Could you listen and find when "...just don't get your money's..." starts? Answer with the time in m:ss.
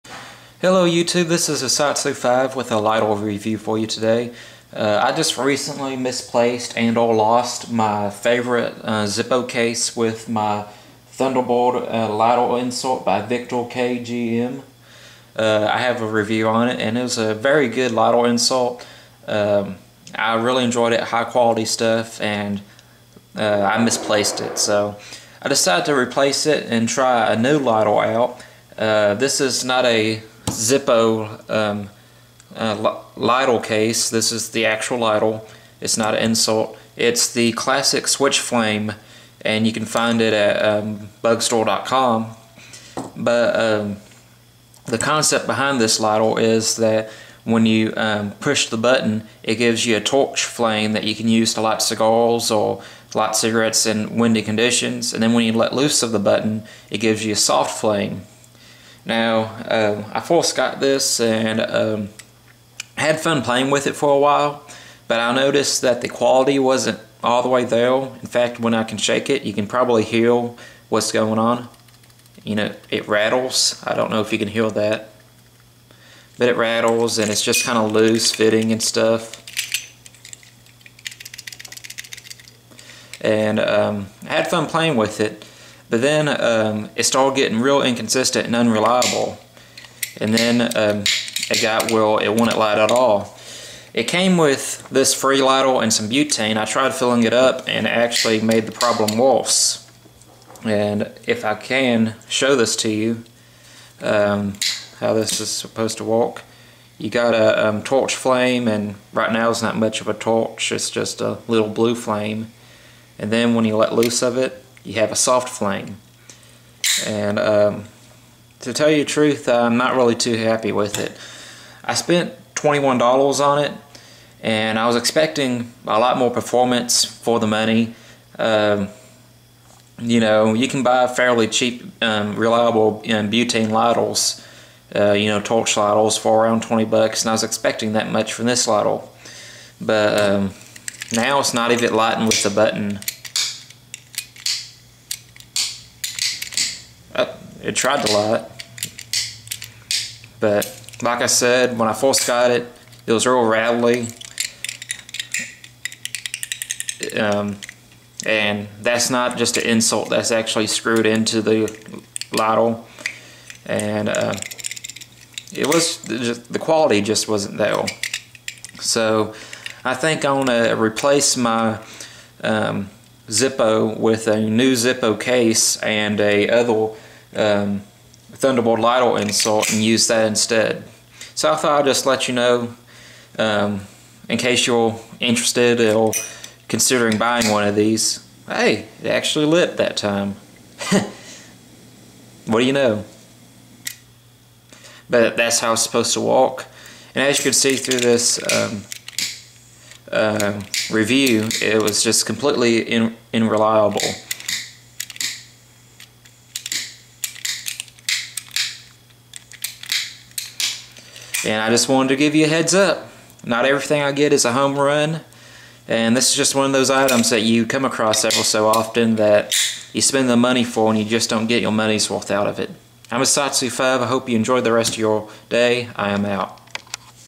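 3:41.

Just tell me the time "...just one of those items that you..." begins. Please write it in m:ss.
3:36.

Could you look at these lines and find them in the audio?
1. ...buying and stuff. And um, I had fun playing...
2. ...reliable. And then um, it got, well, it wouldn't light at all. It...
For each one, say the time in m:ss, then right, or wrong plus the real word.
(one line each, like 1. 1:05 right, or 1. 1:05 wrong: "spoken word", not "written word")
1. 1:18 wrong: "fitting", not "buying"
2. 1:28 wrong: "unreliable", not "reliable".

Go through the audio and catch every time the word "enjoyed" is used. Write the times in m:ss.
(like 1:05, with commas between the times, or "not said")
0:20, 3:44.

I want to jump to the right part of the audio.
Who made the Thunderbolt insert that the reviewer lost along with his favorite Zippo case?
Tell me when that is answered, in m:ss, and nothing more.
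0:13.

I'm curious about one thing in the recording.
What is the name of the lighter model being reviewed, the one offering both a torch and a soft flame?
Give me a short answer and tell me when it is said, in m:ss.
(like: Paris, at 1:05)
Switch flame, at 0:38.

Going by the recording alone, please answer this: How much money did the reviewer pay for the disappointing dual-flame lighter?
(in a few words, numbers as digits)
$21.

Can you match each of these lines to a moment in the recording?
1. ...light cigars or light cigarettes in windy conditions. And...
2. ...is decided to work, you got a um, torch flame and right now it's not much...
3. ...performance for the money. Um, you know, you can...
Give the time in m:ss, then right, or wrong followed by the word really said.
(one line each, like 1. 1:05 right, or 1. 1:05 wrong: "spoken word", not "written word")
1. 0:51 right
2. 1:45 wrong: "supposed", not "decided"
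3. 2:06 right.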